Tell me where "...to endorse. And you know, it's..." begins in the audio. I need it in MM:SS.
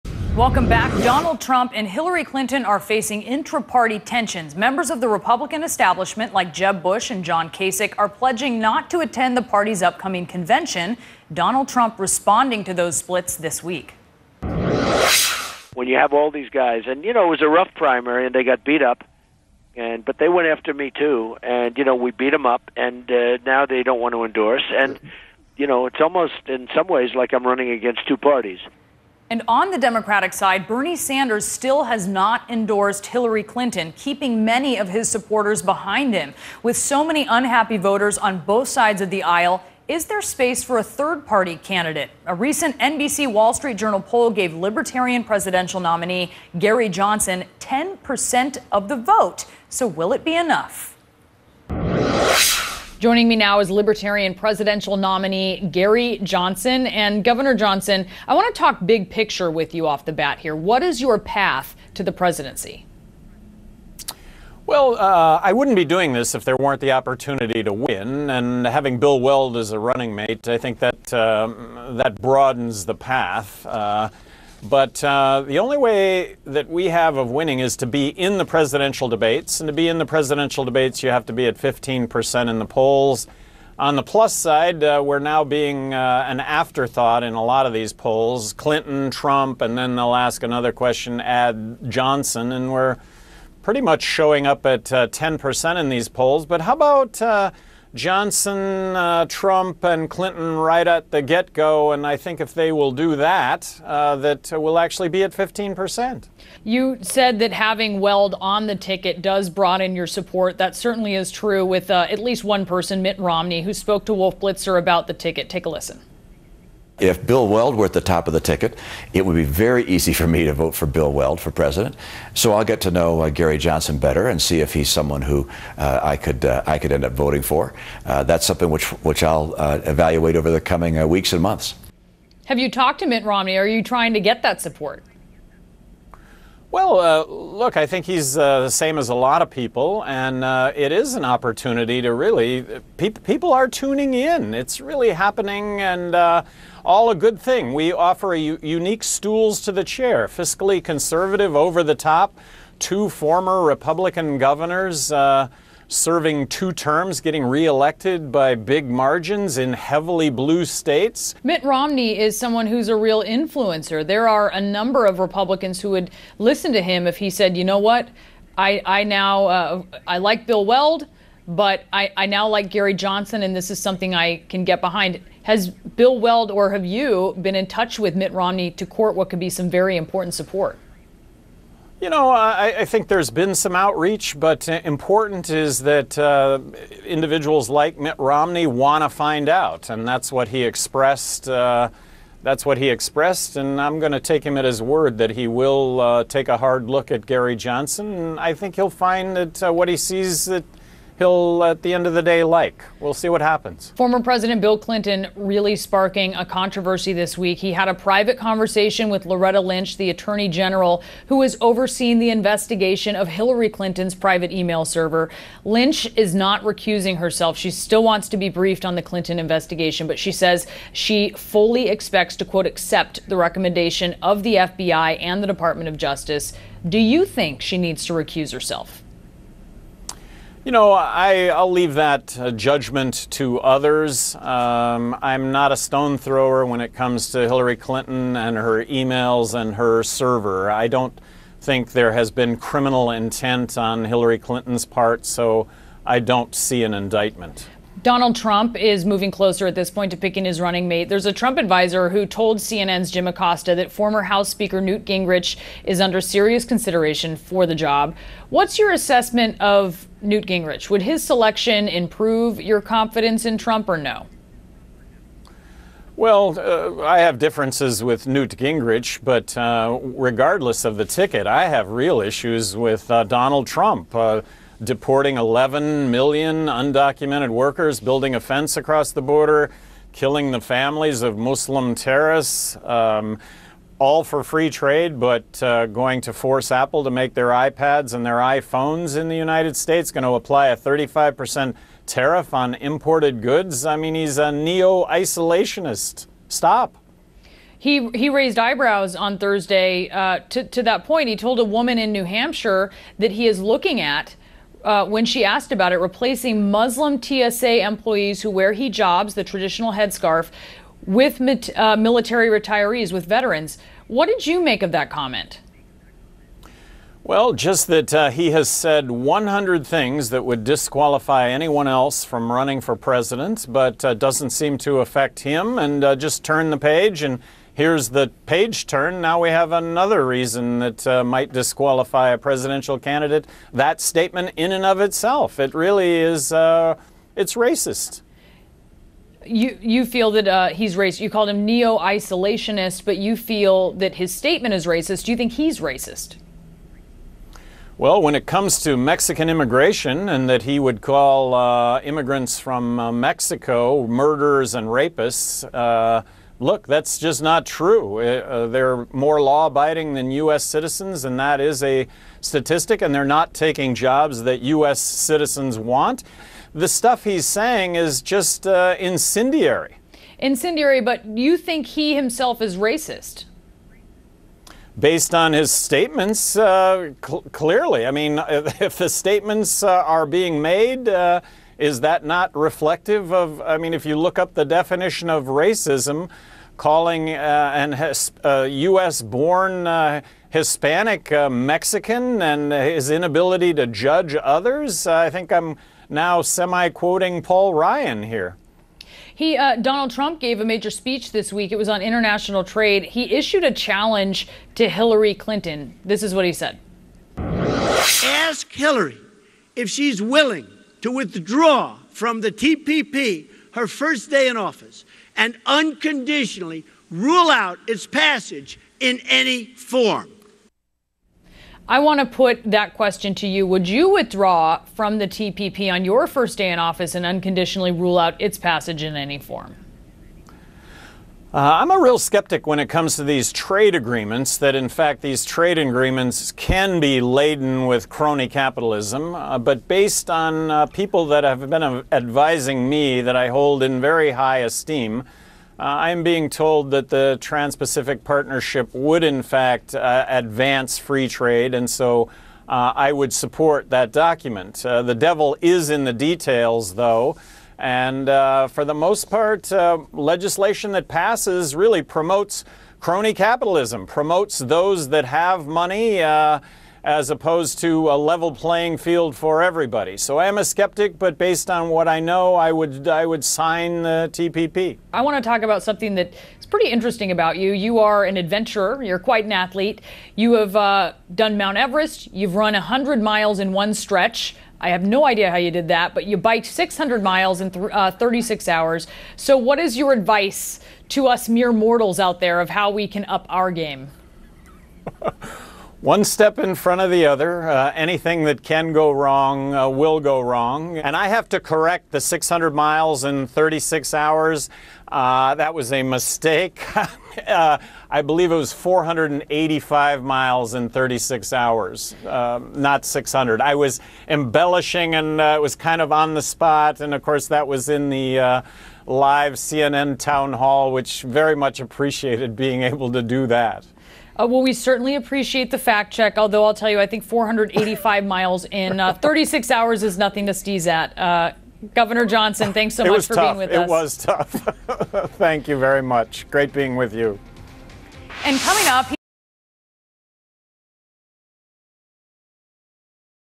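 00:24.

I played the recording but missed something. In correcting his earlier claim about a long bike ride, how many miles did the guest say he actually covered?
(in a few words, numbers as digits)
485.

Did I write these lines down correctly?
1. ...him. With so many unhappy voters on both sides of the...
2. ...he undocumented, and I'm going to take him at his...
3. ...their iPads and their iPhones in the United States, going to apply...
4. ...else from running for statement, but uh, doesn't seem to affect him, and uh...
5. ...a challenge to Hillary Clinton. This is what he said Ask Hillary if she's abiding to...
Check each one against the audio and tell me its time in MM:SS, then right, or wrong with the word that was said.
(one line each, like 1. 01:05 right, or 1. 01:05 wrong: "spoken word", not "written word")
1. 00:36 right
2. 03:12 wrong: "expressed", not "undocumented"
3. 04:47 right
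4. 05:21 wrong: "president", not "statement"
5. 06:43 wrong: "willing", not "abiding".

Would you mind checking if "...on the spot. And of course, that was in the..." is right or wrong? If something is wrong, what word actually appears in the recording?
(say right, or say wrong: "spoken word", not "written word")
right.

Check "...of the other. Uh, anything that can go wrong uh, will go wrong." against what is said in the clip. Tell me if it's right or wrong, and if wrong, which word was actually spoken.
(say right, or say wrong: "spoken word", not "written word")
right.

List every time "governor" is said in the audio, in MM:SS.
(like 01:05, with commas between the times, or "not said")
00:57, 02:34, 08:51.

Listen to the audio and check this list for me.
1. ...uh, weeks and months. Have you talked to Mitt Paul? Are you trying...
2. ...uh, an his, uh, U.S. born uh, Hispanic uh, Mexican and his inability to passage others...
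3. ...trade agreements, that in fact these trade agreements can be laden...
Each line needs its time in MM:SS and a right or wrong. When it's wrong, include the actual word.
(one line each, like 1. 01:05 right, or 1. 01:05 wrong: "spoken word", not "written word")
1. 02:10 wrong: "Romney", not "Paul"
2. 06:27 wrong: "judge", not "passage"
3. 07:13 right.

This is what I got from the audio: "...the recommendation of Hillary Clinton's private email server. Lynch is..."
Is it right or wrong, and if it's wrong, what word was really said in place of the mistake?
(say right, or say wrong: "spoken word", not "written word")
wrong: "investigation", not "recommendation".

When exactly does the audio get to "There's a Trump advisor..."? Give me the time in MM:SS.
04:11.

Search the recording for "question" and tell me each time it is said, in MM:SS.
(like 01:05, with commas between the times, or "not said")
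01:30, 07:02.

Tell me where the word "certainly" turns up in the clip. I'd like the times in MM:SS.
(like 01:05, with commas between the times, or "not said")
01:50, 08:44.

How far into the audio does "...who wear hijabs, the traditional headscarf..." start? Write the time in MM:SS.
05:08.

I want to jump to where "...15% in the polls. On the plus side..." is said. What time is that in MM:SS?
01:21.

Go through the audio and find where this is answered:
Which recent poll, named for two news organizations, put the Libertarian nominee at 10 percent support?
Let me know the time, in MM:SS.
00:42.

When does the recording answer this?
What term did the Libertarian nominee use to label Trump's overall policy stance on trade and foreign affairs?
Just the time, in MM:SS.
04:54.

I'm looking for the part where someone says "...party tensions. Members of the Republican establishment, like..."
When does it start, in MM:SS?
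00:03.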